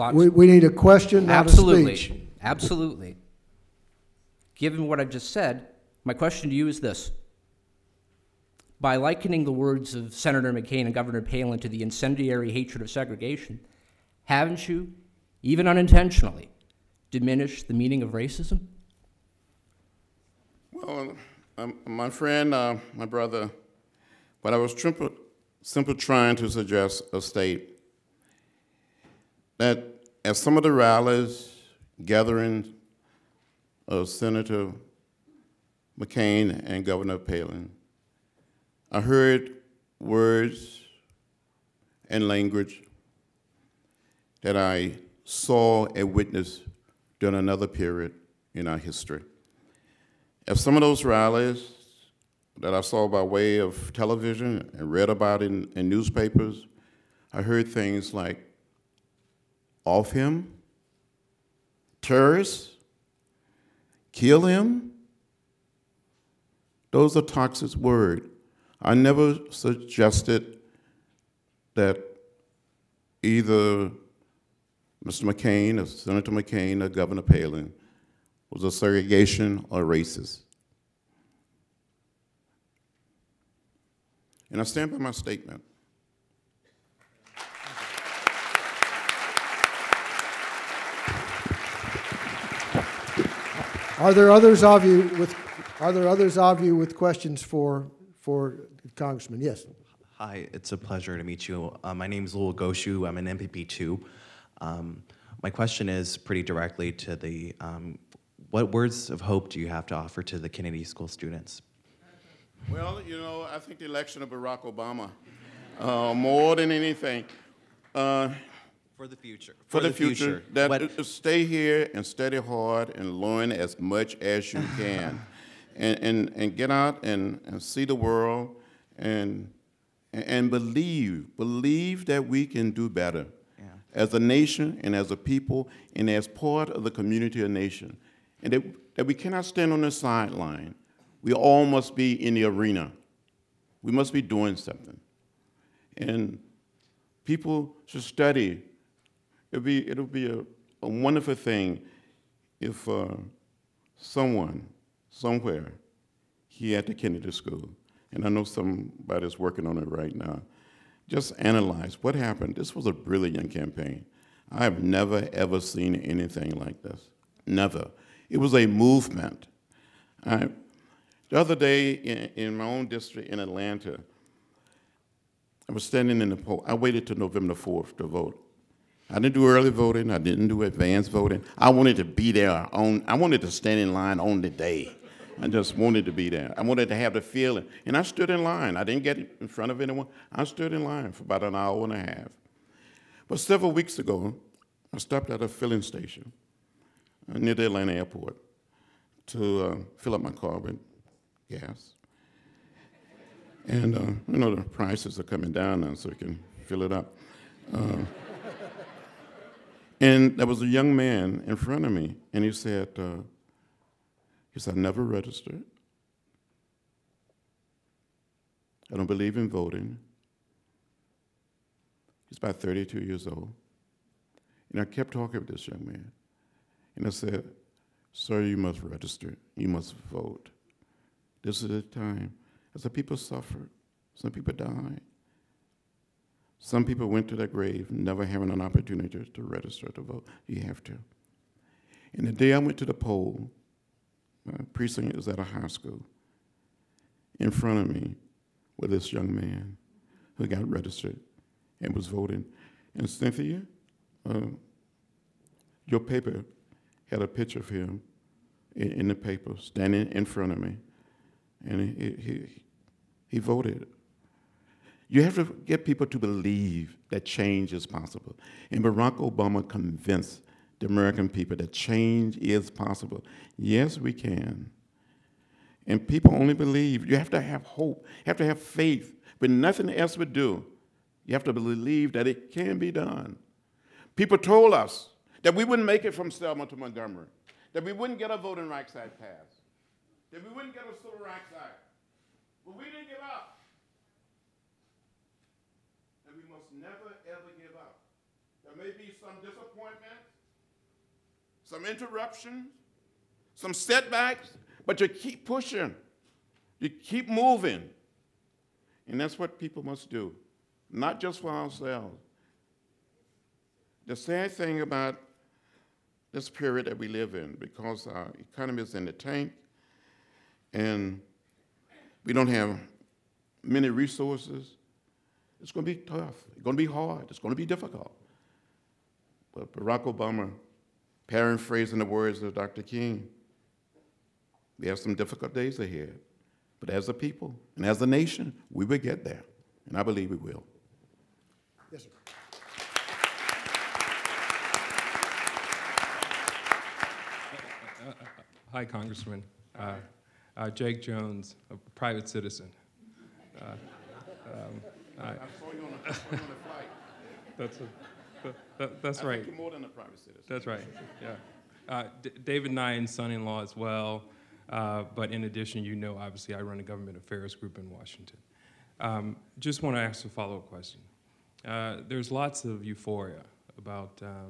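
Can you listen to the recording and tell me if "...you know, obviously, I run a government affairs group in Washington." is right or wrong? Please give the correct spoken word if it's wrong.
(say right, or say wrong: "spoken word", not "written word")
right.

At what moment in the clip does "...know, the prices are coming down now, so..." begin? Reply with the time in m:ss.
3:24.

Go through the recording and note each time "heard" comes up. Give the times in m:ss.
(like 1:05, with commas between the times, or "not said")
0:39, 0:57.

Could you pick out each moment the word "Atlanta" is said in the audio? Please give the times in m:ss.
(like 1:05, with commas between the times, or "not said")
2:53, 3:17.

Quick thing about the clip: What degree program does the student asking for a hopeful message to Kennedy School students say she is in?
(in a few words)
MPP two.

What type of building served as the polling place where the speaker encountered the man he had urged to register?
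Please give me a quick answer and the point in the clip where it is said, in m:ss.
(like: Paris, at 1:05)
high school, at 4:05.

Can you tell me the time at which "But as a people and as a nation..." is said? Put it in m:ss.
5:36.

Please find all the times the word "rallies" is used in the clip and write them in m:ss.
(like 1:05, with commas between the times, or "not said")
0:30, 0:51.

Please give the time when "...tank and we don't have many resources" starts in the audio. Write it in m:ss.
5:19.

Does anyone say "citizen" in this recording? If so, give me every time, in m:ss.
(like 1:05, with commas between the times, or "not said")
5:52, 6:00.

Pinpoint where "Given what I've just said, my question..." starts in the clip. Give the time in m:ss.
0:04.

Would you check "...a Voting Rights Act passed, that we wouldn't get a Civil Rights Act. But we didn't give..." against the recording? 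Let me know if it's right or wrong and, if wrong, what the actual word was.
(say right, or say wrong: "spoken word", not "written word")
right.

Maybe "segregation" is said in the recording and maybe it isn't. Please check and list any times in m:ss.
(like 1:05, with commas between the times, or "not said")
0:12, 1:18.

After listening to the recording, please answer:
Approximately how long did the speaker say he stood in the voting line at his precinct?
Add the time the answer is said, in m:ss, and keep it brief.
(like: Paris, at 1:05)
an hour and a half, at 3:11.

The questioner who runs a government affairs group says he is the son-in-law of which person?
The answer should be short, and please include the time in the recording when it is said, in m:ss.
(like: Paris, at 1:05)
David Nyhan, at 6:02.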